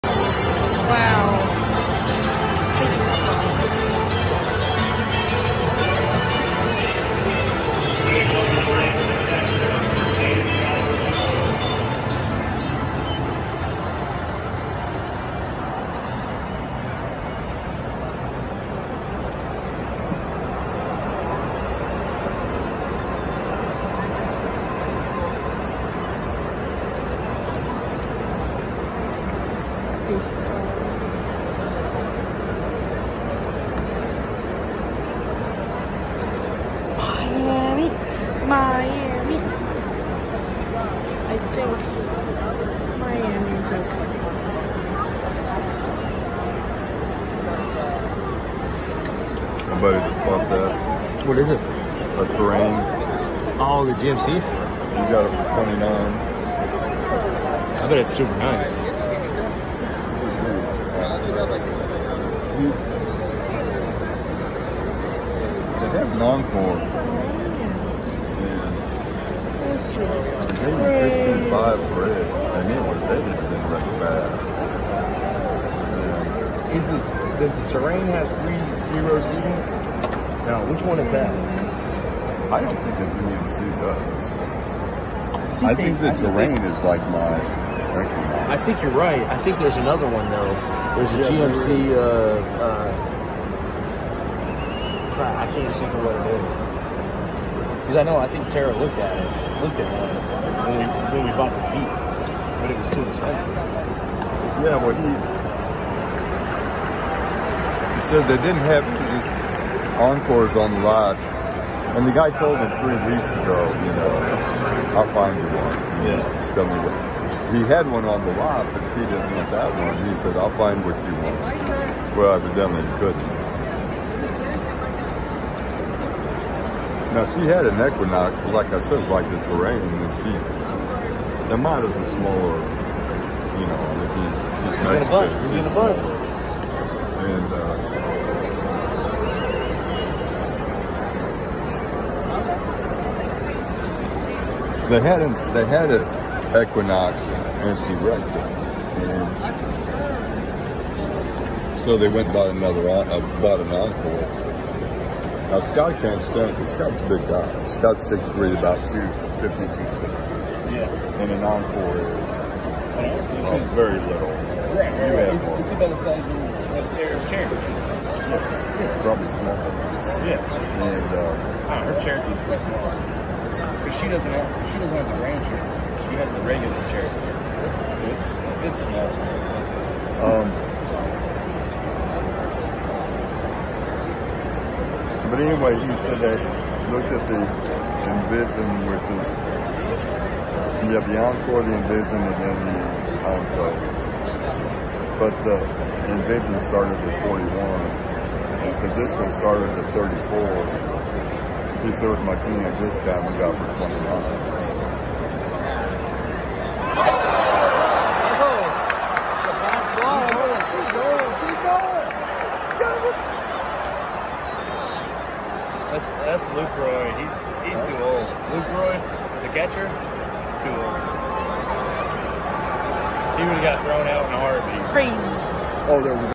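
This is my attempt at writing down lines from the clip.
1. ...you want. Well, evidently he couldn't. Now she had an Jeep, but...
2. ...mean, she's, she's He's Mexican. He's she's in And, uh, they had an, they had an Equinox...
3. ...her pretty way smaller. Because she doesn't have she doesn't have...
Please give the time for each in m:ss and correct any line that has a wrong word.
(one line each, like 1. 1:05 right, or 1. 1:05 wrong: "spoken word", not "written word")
1. 2:00 wrong: "Equinox", not "Jeep"
2. 2:13 right
3. 2:51 right.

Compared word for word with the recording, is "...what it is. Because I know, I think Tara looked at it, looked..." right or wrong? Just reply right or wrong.
right.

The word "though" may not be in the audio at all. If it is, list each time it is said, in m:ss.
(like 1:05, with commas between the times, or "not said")
1:30.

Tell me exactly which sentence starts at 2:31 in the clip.
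And so they went by another, uh, bought an Encore.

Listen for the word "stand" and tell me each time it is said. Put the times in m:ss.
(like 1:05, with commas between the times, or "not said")
2:36.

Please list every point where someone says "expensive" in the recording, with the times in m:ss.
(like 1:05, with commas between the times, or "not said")
1:43.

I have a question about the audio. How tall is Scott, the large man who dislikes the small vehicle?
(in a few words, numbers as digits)
6'3".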